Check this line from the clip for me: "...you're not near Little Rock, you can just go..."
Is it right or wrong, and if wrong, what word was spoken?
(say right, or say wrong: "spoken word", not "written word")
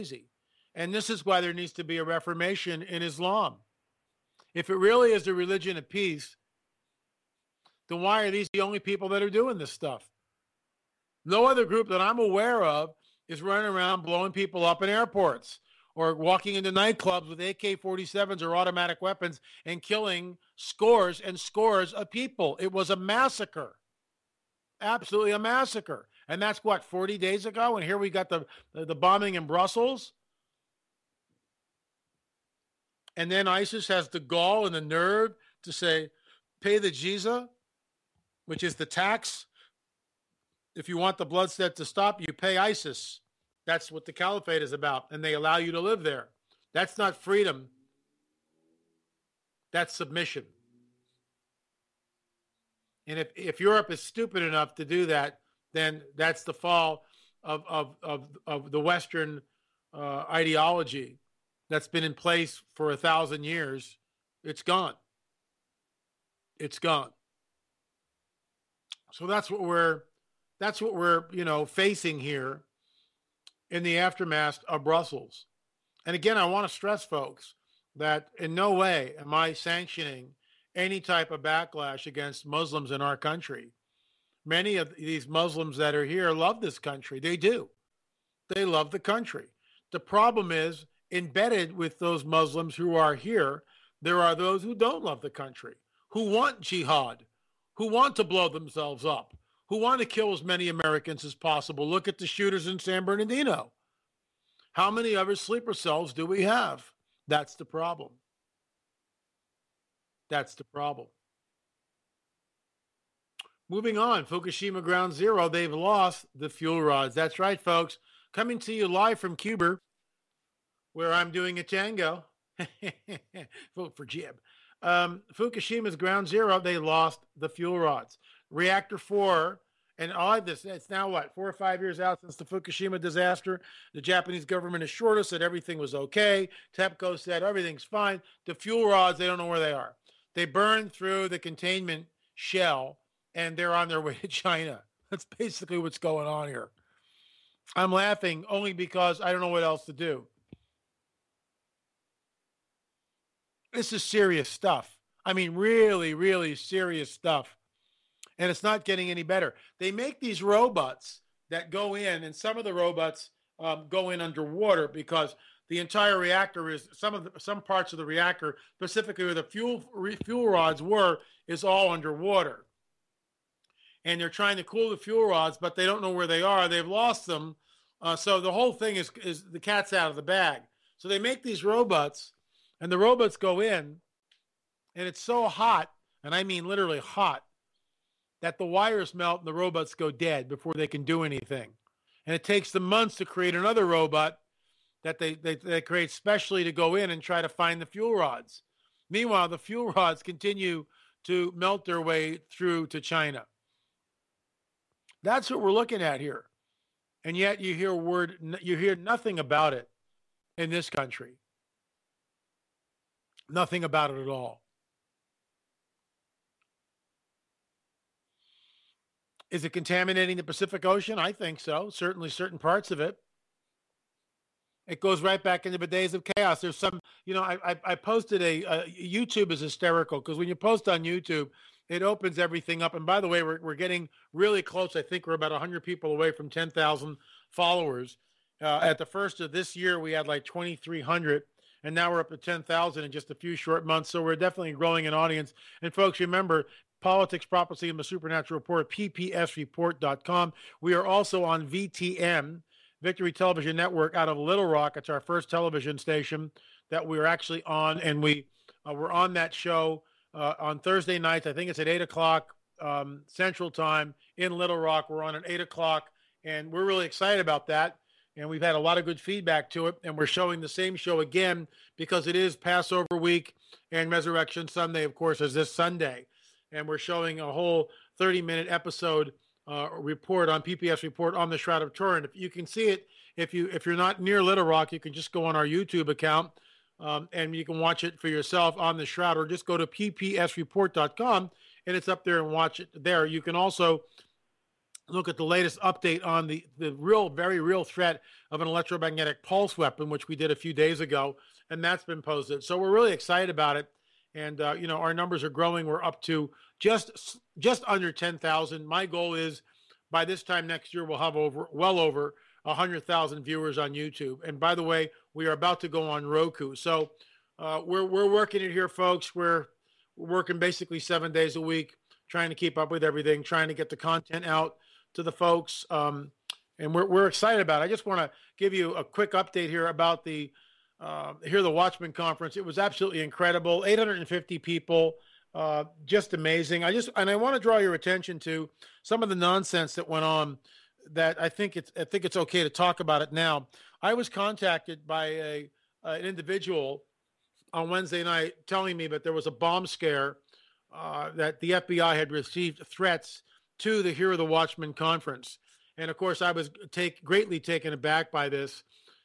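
right.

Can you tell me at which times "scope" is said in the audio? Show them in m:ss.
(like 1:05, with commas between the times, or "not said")
not said.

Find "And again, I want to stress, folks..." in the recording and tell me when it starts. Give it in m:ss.
1:16.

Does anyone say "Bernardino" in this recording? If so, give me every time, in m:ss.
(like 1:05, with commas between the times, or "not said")
1:43.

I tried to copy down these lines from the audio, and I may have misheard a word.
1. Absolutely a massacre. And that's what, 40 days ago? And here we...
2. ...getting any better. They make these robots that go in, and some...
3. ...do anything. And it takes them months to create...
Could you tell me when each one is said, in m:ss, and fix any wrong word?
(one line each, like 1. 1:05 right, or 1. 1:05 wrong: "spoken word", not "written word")
1. 0:24 right
2. 2:38 right
3. 3:11 right.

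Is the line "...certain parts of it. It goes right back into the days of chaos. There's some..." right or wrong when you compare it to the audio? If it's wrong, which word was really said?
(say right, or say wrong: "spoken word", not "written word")
right.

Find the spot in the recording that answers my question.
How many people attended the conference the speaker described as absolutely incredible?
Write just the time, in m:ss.
5:33.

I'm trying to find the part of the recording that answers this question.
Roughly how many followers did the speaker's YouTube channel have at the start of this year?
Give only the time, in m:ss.
4:00.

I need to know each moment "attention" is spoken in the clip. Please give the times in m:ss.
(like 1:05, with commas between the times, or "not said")
5:37.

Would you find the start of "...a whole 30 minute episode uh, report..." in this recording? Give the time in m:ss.
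4:37.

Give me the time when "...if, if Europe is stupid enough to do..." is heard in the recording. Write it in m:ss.
0:53.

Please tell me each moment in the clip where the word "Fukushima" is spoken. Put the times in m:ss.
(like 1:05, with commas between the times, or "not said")
1:54, 2:05, 2:12.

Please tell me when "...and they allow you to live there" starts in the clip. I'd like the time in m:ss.
0:45.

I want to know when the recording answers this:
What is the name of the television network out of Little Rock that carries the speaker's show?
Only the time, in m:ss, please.
4:13.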